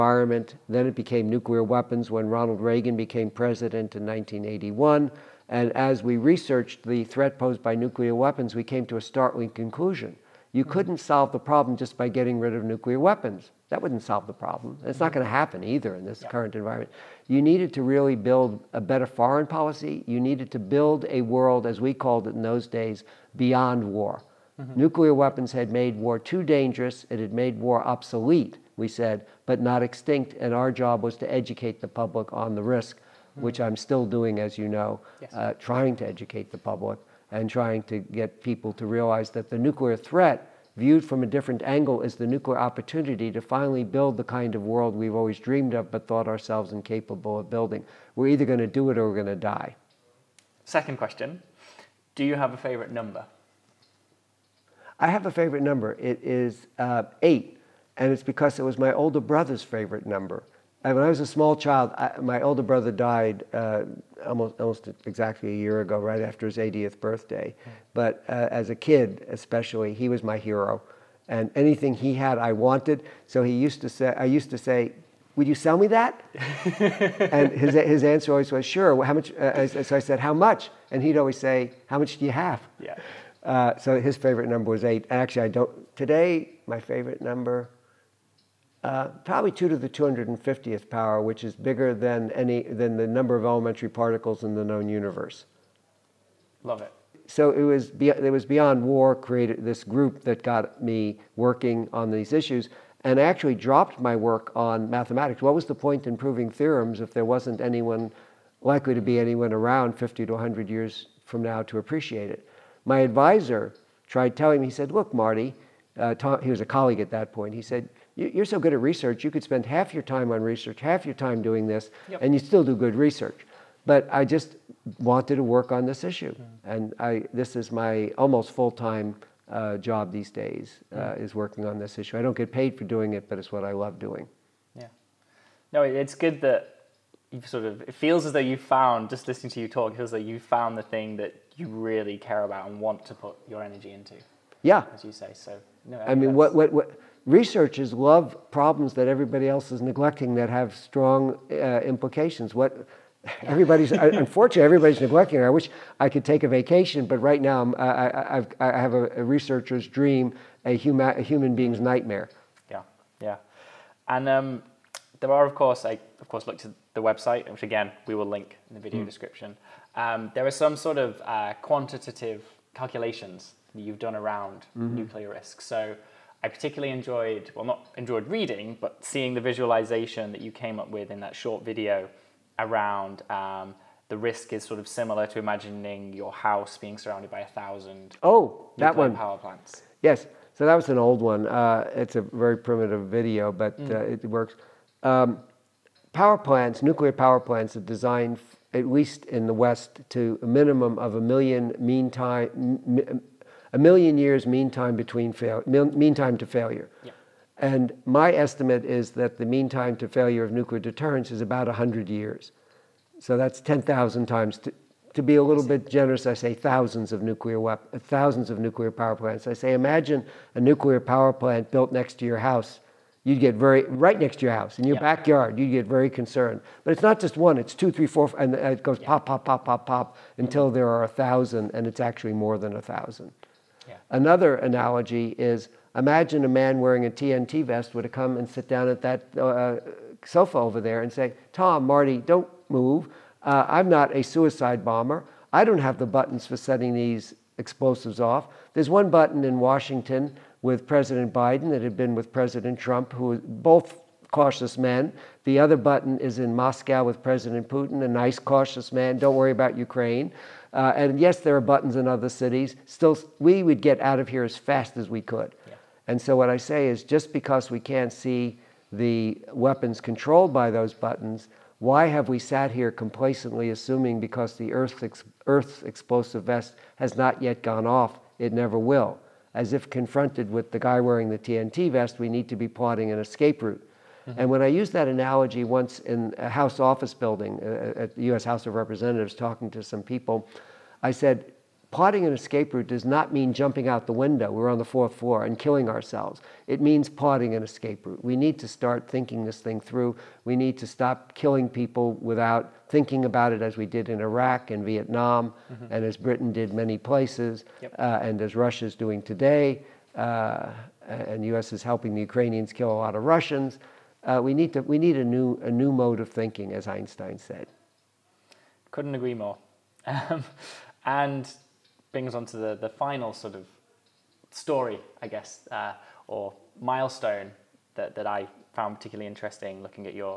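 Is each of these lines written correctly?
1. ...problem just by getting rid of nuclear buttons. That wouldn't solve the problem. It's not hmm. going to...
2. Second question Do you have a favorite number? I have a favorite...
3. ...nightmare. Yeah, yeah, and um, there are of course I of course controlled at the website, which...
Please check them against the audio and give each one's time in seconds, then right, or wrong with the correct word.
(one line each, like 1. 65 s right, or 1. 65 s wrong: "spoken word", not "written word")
1. 11 s wrong: "weapons", not "buttons"
2. 50 s right
3. 161 s wrong: "looked", not "controlled".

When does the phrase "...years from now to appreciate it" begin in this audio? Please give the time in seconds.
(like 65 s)
110 s.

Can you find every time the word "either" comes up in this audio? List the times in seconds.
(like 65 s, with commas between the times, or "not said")
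15 s, 48 s.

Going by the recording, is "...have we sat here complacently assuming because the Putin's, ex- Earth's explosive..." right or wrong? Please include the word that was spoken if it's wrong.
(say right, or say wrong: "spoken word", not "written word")
wrong: "Earth", not "Putin".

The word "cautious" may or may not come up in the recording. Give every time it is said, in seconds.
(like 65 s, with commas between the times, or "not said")
254 s, 258 s.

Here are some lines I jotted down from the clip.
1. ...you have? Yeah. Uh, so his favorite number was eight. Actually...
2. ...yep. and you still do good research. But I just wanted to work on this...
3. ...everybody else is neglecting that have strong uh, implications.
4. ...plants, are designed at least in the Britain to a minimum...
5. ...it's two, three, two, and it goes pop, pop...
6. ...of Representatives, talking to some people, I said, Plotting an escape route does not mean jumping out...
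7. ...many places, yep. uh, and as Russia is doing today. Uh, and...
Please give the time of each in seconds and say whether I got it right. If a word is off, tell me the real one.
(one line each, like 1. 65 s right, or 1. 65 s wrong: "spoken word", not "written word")
1. 82 s right
2. 122 s right
3. 149 s right
4. 197 s wrong: "West", not "Britain"
5. 227 s wrong: "four", not "two"
6. 288 s right
7. 306 s right.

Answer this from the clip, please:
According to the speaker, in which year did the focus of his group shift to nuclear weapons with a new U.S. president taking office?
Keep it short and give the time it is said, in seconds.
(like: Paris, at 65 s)
1981, at 4 s.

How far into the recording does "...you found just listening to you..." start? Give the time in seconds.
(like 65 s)
138 s.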